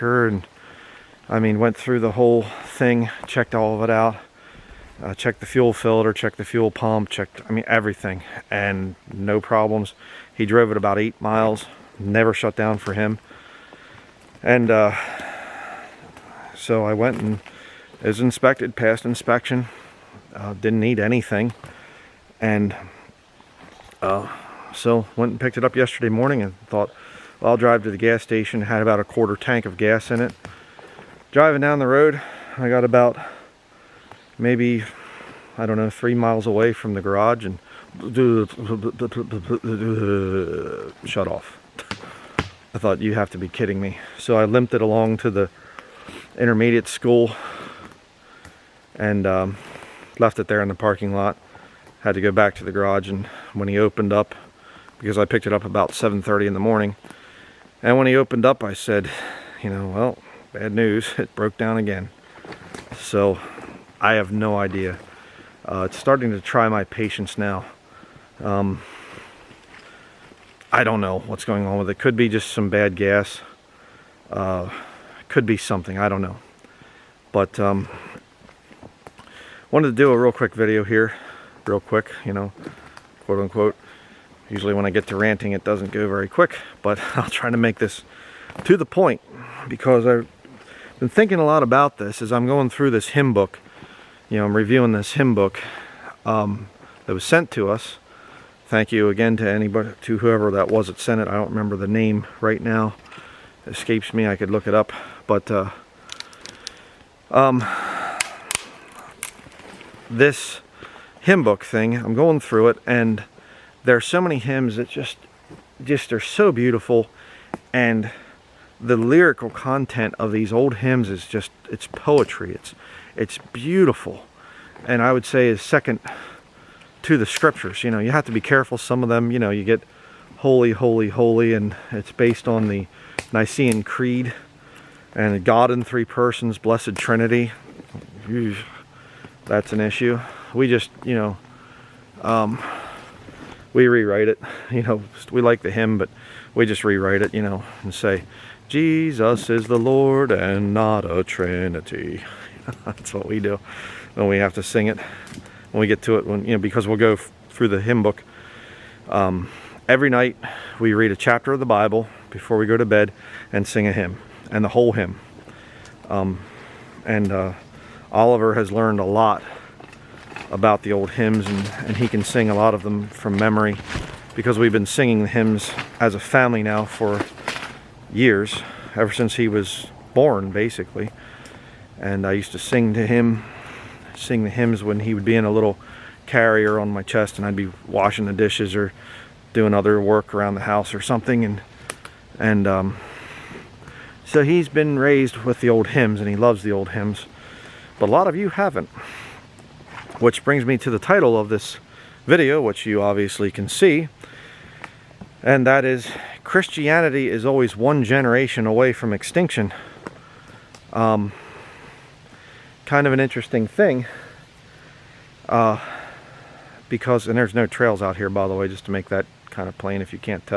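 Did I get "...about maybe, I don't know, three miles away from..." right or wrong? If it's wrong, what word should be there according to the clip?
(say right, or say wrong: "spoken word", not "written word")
right.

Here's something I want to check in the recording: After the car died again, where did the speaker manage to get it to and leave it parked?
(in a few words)
the intermediate school.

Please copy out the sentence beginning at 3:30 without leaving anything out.
Um, kind of an interesting thing.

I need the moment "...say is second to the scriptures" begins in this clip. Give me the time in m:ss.
2:05.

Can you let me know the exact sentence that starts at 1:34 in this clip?
You know, I'm reviewing this hymn book um, that was sent to us.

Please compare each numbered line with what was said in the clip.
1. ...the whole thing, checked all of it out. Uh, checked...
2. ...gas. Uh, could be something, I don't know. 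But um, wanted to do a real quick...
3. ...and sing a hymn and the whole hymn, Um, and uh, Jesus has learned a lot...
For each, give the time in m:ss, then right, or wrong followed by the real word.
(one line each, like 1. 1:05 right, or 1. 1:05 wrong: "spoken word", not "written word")
1. 0:01 right
2. 1:12 right
3. 2:43 wrong: "Oliver", not "Jesus".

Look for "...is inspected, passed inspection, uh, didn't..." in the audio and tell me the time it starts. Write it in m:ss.
0:18.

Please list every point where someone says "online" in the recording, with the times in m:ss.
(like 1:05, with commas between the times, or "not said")
not said.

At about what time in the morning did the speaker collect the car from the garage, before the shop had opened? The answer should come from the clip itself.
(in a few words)
7:30.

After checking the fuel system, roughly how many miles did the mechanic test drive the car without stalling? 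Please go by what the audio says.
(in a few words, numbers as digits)
8.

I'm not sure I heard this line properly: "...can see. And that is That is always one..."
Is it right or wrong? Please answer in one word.
wrong.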